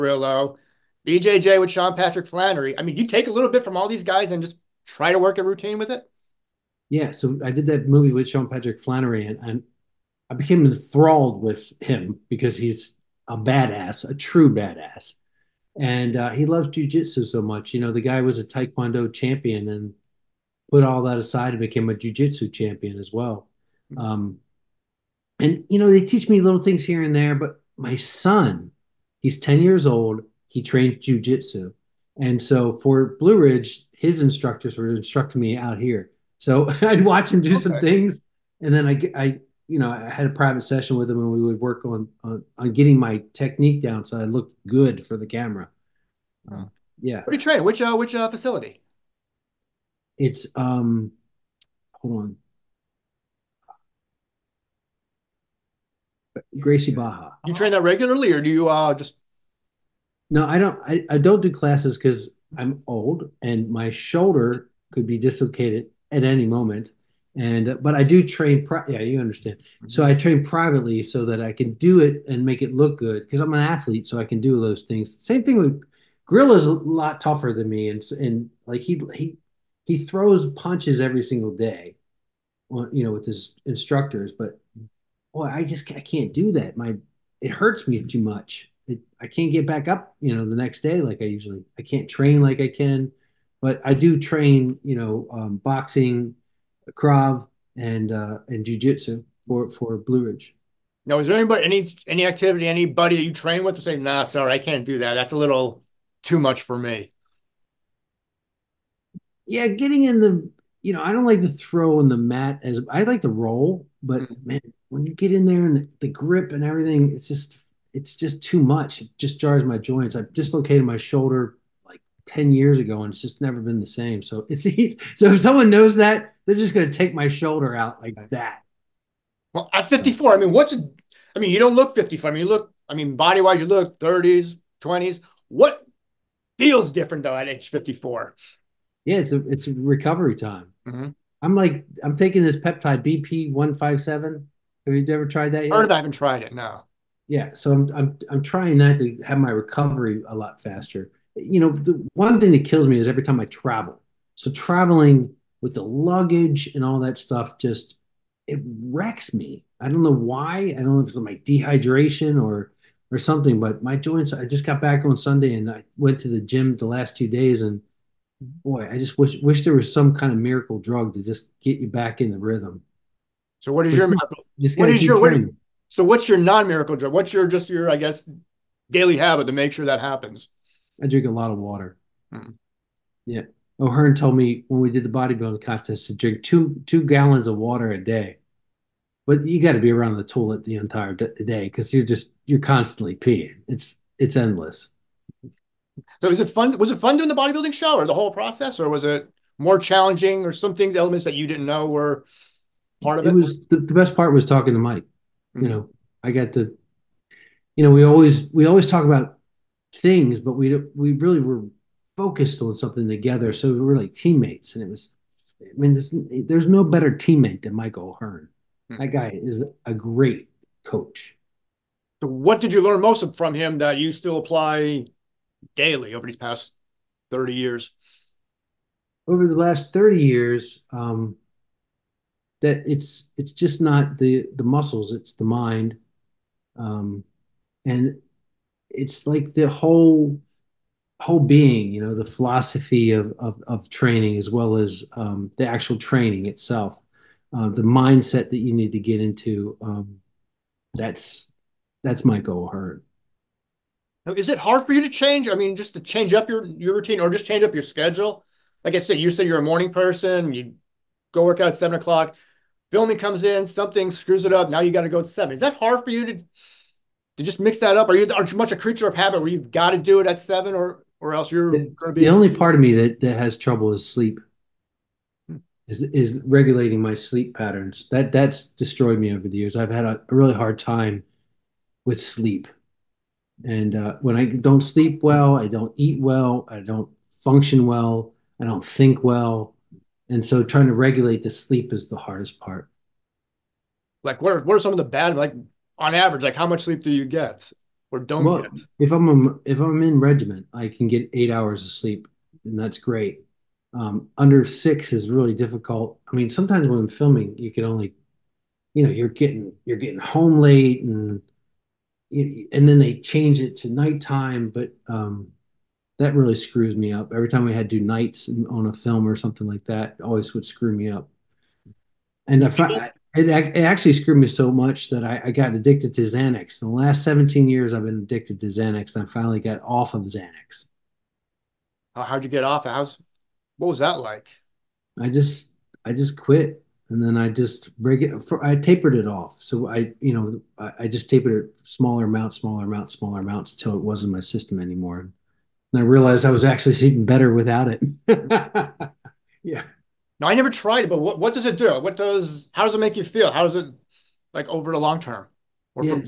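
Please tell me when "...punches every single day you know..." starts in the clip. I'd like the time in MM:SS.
01:20.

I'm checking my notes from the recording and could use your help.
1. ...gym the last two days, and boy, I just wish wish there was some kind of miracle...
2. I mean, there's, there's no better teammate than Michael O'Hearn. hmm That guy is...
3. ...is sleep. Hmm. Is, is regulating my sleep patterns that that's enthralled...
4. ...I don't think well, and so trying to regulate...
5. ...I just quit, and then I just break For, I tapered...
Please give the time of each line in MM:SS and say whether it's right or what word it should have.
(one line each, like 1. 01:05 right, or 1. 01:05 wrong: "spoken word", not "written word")
1. 02:46 right
2. 03:35 right
3. 04:33 wrong: "destroyed", not "enthralled"
4. 04:48 right
5. 05:36 right.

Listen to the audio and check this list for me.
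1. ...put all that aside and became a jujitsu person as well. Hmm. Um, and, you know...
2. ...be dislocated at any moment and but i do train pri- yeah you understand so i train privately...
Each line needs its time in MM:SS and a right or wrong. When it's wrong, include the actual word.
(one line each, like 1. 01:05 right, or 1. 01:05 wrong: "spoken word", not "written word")
1. 00:20 wrong: "champion", not "person"
2. 01:05 right.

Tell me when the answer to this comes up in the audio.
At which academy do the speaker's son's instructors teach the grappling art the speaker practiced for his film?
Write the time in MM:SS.
00:56.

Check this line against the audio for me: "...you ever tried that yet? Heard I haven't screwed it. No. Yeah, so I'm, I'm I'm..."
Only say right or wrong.
wrong.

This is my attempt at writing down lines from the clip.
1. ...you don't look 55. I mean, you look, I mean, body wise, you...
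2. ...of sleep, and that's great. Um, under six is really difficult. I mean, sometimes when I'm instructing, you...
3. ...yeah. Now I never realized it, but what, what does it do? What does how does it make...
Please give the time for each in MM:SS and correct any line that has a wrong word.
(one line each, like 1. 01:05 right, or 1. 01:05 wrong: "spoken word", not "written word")
1. 02:11 right
2. 05:01 wrong: "filming", not "instructing"
3. 05:49 wrong: "tried", not "realized".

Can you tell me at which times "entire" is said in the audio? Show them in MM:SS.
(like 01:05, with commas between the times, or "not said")
03:10.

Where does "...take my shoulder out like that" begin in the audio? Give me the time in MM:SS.
02:06.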